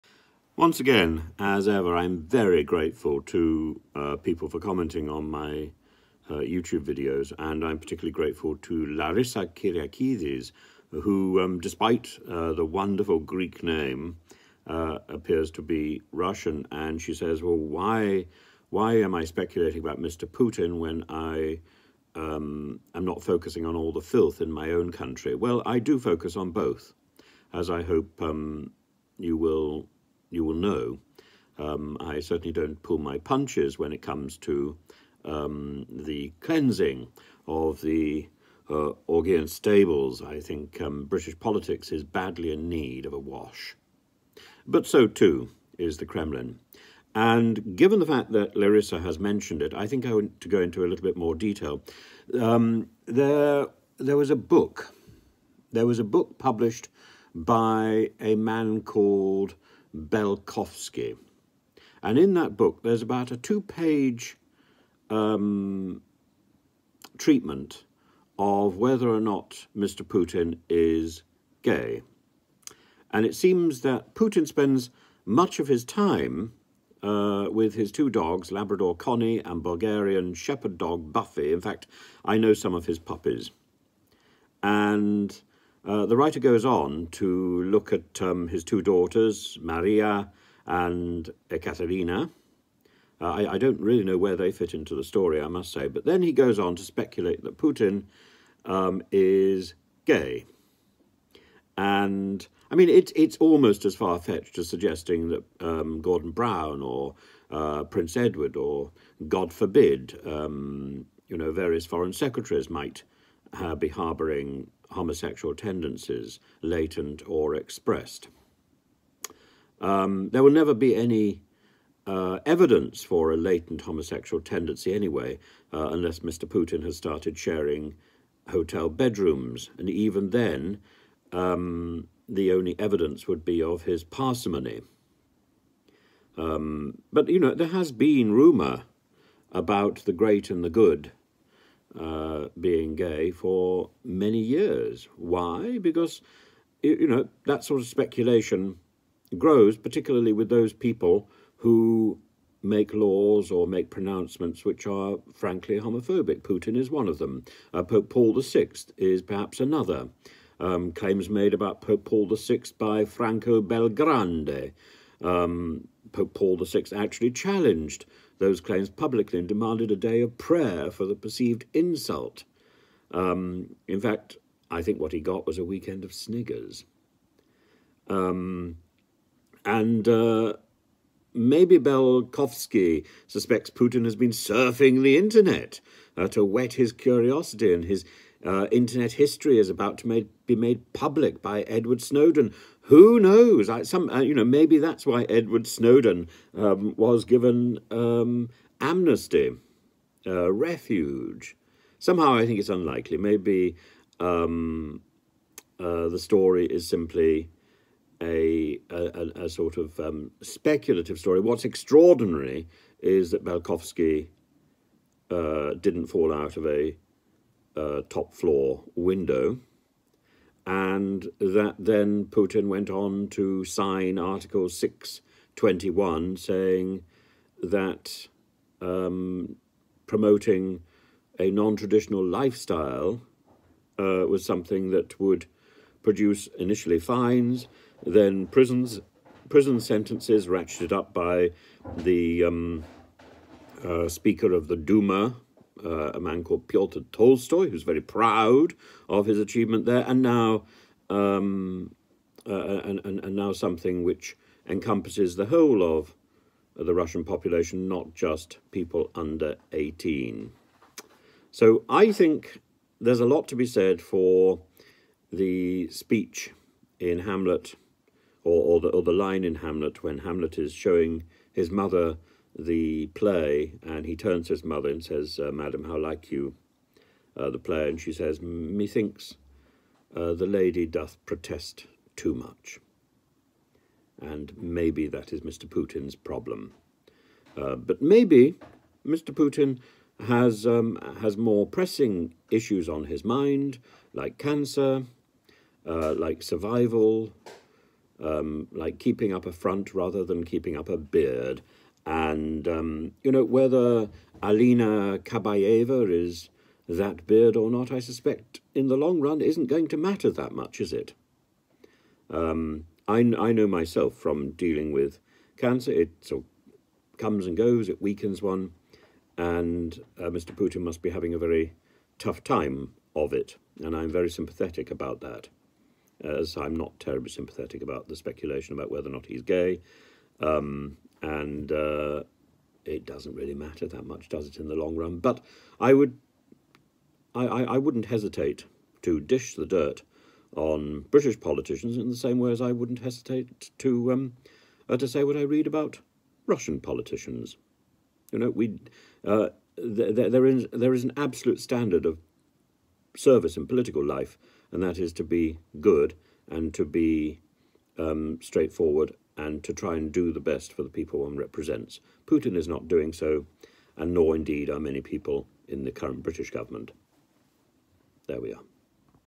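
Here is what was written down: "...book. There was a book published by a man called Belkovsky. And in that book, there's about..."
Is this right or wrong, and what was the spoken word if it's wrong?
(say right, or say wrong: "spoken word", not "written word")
right.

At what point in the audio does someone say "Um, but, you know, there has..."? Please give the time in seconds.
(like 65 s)
136 s.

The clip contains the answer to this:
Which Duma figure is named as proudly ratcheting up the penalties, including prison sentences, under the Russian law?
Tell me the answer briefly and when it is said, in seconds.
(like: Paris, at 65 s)
Pyotr Tolstoy, at 246 s.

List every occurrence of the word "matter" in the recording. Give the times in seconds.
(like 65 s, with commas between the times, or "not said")
309 s, 333 s.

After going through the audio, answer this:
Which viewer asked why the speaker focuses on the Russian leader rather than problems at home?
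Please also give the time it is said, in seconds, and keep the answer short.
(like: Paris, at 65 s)
Larissa Kyriakides, at 8 s.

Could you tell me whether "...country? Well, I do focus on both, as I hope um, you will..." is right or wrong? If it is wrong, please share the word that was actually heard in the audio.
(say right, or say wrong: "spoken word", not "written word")
right.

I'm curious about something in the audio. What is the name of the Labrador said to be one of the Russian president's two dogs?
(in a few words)
Connie.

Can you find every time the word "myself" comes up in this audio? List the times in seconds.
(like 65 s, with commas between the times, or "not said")
313 s.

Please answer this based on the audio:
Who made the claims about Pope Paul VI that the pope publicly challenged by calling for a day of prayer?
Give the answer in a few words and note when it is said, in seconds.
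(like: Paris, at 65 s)
Franco Bellegrandi, at 163 s.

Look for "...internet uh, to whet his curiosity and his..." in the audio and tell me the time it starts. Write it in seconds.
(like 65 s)
185 s.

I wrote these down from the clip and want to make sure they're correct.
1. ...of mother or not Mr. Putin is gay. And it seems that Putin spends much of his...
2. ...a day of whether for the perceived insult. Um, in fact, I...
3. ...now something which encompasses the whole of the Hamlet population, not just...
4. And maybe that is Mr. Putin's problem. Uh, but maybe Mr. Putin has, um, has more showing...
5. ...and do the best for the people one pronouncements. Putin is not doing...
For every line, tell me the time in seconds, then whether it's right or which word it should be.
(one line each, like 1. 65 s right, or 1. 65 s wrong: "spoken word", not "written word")
1. 68 s wrong: "whether", not "mother"
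2. 169 s wrong: "prayer", not "whether"
3. 253 s wrong: "Russian", not "Hamlet"
4. 284 s wrong: "pressing", not "showing"
5. 359 s wrong: "represents", not "pronouncements".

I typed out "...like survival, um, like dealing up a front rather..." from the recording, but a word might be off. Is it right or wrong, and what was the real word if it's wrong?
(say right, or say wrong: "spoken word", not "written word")
wrong: "keeping", not "dealing".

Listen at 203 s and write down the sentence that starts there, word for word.
Maybe um, uh, the story is simply a, a, a sort of um, speculative story.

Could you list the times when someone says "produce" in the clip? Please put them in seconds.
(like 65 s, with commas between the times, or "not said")
236 s.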